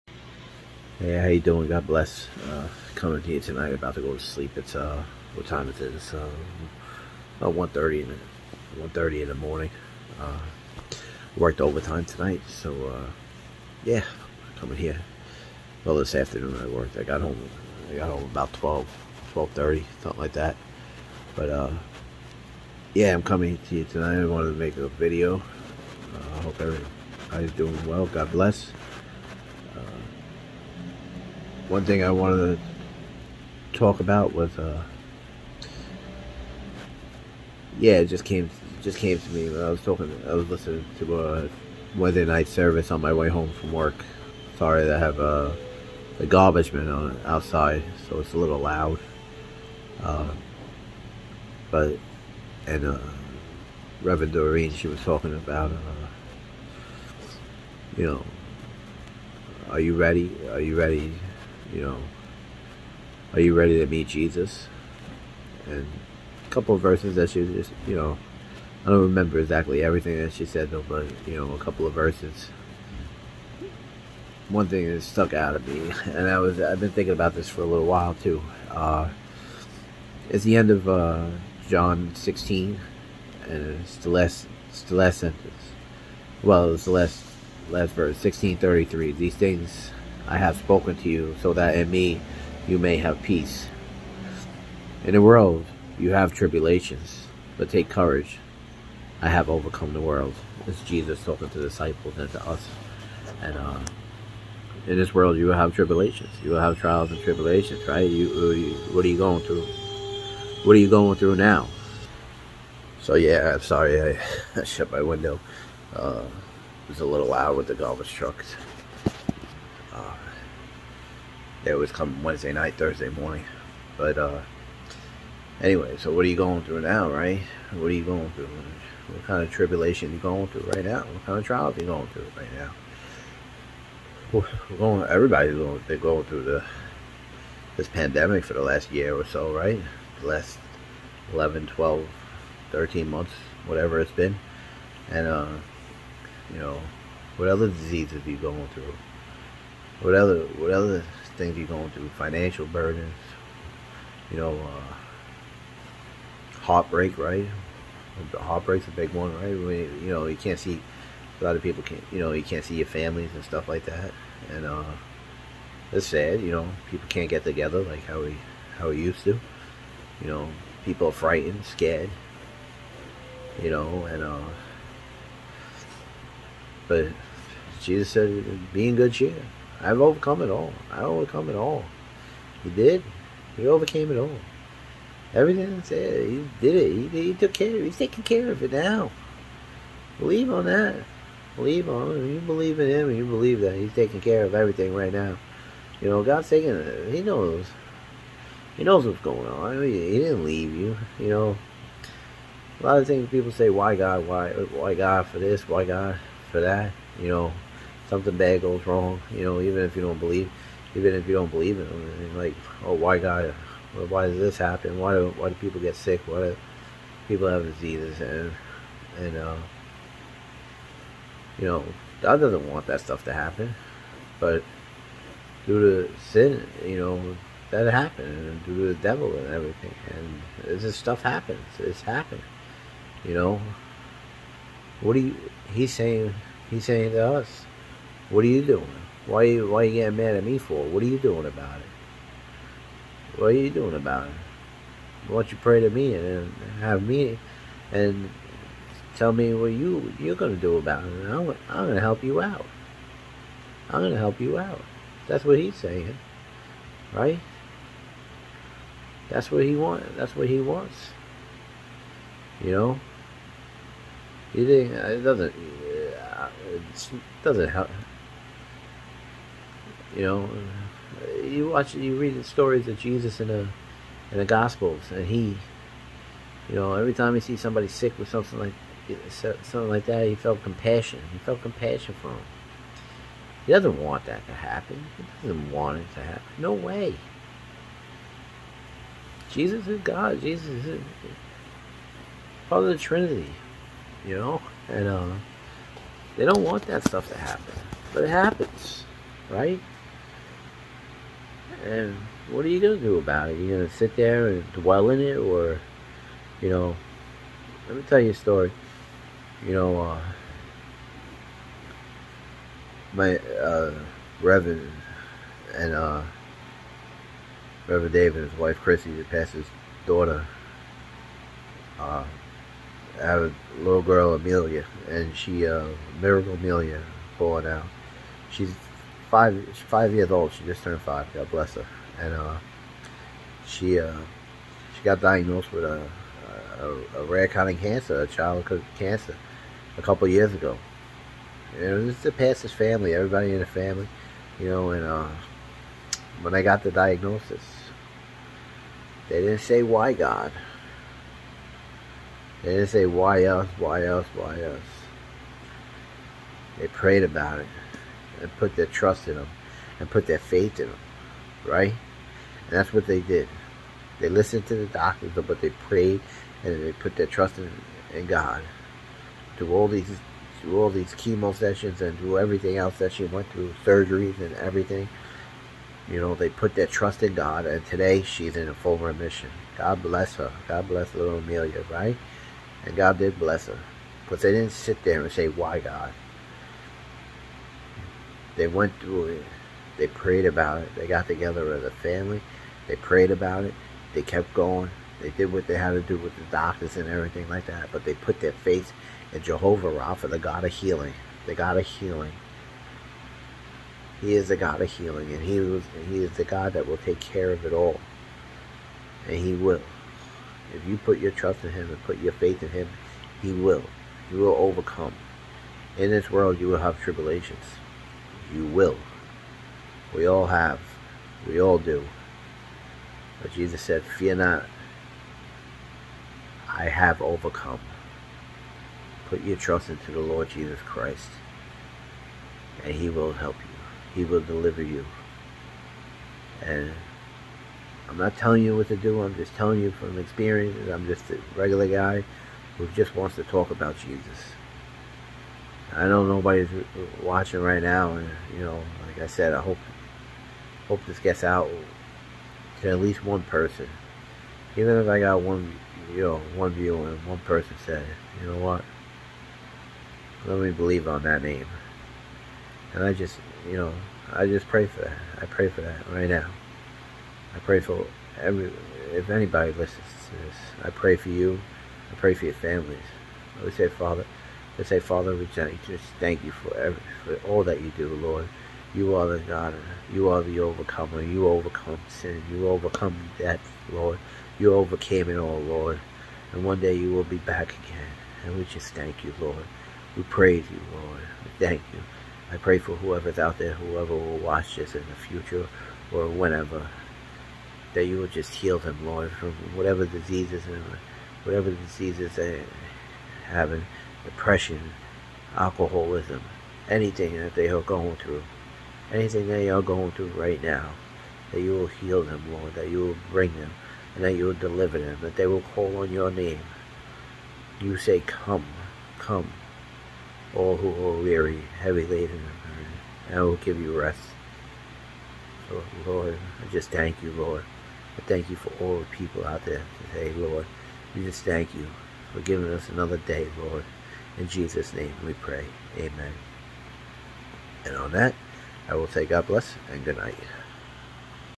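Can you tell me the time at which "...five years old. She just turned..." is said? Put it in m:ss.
5:29.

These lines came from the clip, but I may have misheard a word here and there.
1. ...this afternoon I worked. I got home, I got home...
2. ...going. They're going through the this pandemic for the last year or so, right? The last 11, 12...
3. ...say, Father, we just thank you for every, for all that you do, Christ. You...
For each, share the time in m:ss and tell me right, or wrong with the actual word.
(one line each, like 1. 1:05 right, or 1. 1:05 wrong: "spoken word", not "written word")
1. 0:15 right
2. 2:15 right
3. 7:54 wrong: "Lord", not "Christ".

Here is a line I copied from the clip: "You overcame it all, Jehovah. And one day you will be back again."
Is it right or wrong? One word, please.
wrong.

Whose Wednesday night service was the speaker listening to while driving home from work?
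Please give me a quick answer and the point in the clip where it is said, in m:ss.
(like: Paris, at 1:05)
Reverend Doreen, at 0:54.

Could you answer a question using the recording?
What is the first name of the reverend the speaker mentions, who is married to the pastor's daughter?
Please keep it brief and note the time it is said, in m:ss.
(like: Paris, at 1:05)
Dave, at 5:17.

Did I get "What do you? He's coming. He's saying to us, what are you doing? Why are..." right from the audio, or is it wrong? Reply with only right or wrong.
wrong.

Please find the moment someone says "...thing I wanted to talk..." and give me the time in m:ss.
0:31.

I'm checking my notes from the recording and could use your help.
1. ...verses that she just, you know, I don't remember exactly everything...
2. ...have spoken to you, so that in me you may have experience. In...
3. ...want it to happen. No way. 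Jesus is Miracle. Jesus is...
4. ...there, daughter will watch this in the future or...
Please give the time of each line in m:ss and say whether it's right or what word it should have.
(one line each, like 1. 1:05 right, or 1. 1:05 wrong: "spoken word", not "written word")
1. 1:06 right
2. 1:30 wrong: "peace", not "experience"
3. 4:45 wrong: "God", not "Miracle"
4. 8:13 wrong: "whoever", not "daughter".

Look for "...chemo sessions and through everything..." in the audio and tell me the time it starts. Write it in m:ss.
6:11.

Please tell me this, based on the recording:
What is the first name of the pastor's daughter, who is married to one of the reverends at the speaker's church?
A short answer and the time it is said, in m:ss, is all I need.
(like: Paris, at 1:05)
Chrissy, at 5:18.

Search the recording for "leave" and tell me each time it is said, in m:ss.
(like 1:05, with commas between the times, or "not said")
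3:20.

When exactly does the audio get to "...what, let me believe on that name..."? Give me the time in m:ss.
7:38.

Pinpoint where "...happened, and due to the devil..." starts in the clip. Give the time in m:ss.
3:47.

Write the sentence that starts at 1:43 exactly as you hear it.
And uh, in this world, you will have tribulations.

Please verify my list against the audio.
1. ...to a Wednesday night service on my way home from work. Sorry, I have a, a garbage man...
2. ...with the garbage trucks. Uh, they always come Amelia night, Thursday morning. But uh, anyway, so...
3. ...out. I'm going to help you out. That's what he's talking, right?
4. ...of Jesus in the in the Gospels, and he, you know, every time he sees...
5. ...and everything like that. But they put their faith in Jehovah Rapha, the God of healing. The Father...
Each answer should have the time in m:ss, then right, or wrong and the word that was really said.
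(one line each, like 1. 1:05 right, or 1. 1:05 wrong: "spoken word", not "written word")
1. 0:40 right
2. 1:57 wrong: "Wednesday", not "Amelia"
3. 4:12 wrong: "saying", not "talking"
4. 4:32 right
5. 6:36 wrong: "God", not "Father".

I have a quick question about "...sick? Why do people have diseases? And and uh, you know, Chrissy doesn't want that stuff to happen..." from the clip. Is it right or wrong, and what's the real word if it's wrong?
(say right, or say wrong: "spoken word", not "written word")
wrong: "God", not "Chrissy".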